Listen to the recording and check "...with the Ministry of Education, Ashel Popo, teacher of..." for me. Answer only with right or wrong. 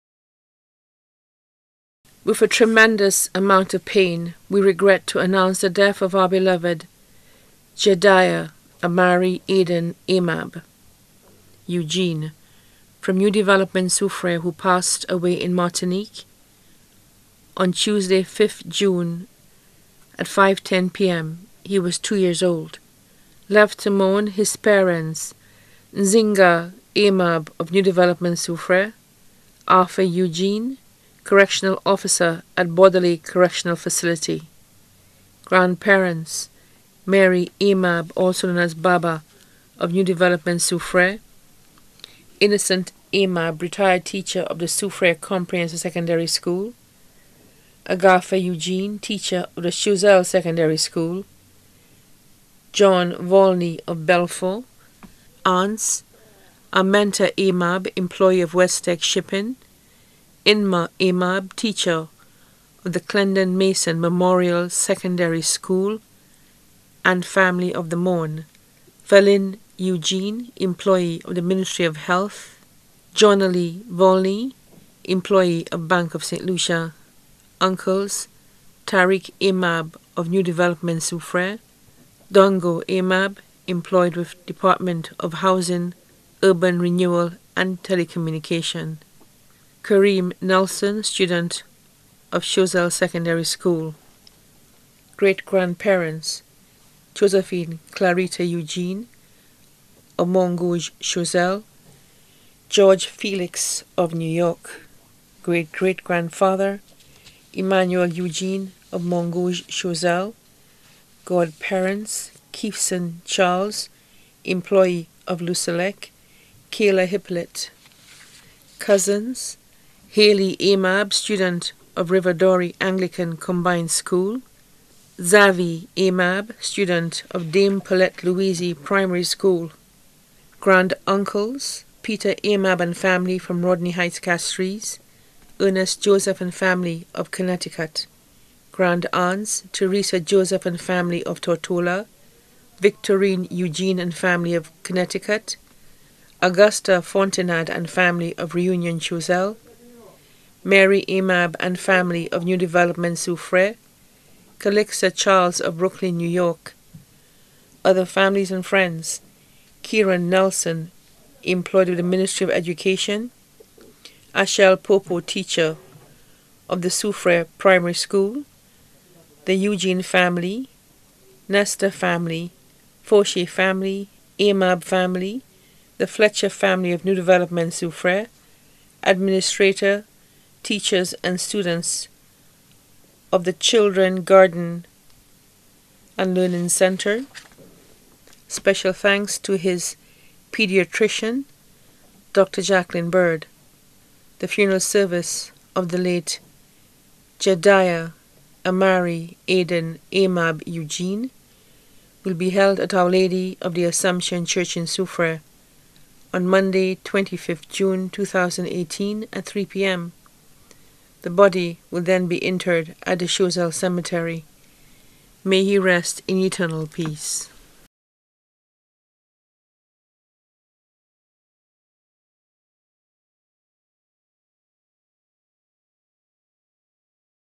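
right.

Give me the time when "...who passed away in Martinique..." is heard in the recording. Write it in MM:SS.
00:14.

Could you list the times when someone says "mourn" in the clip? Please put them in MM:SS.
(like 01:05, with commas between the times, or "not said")
00:23, 01:07.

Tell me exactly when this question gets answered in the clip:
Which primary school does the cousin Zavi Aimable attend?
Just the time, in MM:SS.
02:07.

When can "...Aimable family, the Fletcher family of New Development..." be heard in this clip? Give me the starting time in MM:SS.
02:54.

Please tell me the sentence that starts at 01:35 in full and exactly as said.
Great grandparents Josephine Clarita Eugene, Mongouge Choiseul, George Felix of New York.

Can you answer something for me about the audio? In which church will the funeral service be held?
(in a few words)
Our Lady of the Assumption Church.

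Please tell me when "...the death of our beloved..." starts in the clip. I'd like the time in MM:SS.
00:05.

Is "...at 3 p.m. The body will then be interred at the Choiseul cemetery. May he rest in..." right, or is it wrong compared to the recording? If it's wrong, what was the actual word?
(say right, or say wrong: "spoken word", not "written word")
right.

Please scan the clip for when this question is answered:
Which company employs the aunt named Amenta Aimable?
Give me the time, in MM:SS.
00:58.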